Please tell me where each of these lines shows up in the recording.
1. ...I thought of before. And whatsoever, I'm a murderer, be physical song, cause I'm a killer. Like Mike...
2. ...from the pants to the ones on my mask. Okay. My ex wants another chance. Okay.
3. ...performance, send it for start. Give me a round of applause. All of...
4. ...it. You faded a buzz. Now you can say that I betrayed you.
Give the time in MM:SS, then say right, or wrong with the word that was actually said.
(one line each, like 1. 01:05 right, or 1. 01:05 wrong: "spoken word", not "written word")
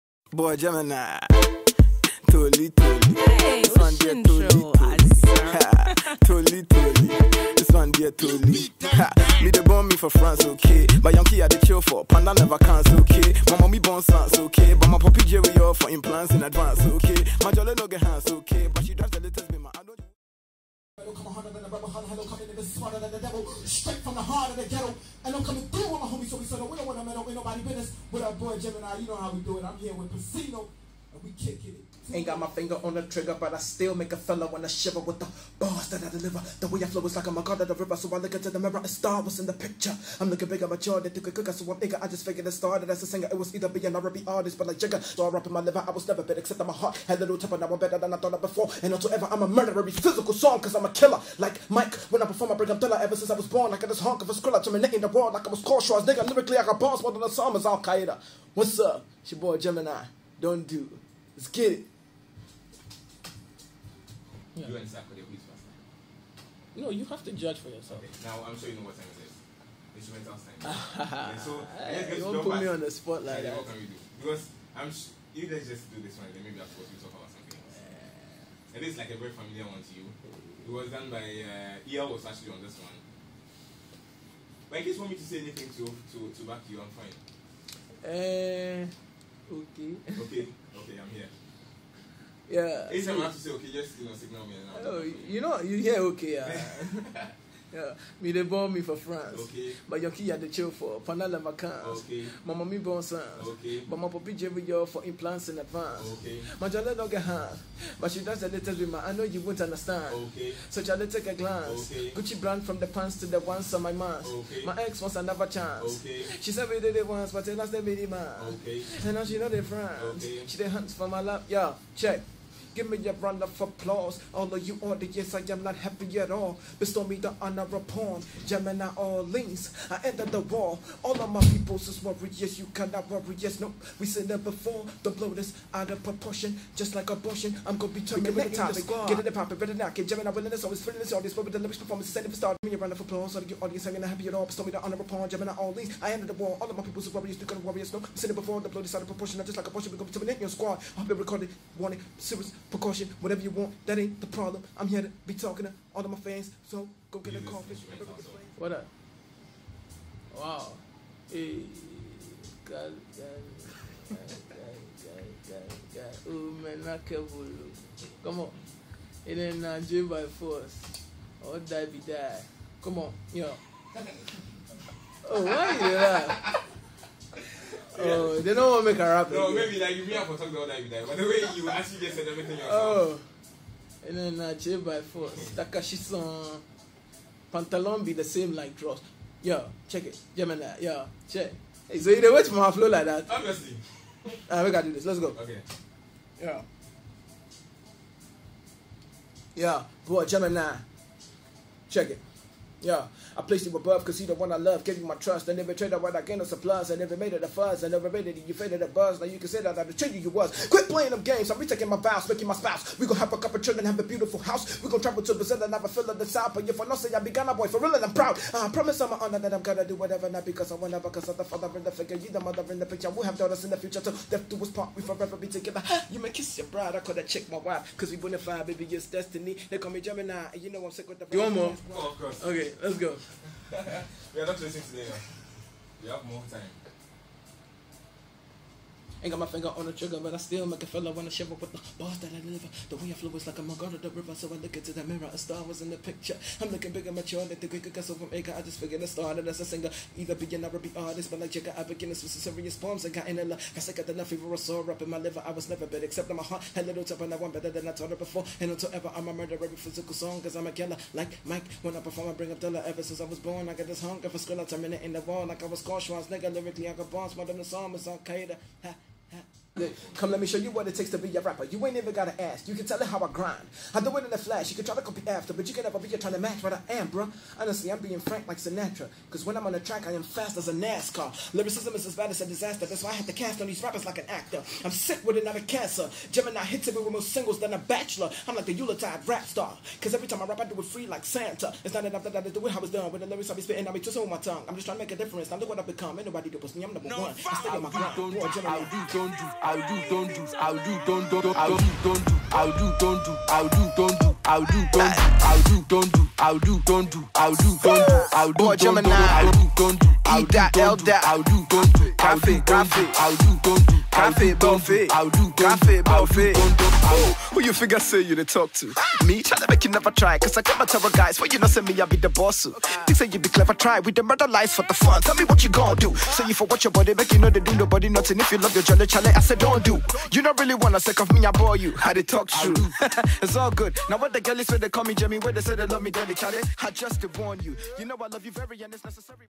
1. 00:48 right
2. 01:52 right
3. 02:21 right
4. 03:28 right.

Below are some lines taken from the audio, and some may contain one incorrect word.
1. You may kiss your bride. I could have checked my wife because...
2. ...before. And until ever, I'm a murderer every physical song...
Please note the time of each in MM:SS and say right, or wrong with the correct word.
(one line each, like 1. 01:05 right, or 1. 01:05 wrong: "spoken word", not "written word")
1. 03:46 right
2. 04:18 right.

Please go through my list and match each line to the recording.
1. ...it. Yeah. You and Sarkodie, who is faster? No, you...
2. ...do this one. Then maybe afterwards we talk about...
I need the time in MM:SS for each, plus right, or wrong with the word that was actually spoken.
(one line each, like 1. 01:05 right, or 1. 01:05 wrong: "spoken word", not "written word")
1. 01:01 right
2. 01:15 right.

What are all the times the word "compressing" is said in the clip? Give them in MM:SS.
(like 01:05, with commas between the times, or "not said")
not said.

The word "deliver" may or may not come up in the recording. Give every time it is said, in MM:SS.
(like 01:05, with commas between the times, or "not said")
00:36, 04:02.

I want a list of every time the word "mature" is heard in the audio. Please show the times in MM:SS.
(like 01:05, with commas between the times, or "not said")
00:40, 04:07.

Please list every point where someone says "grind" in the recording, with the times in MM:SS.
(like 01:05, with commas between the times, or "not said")
04:33, 04:57.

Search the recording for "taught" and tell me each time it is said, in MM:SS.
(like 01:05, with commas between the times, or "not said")
04:17.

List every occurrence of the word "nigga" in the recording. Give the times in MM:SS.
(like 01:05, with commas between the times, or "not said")
00:22, 00:56, 04:26.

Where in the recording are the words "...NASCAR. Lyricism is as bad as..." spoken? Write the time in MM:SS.
04:40.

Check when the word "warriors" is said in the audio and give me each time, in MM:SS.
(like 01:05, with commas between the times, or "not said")
02:12, 02:27.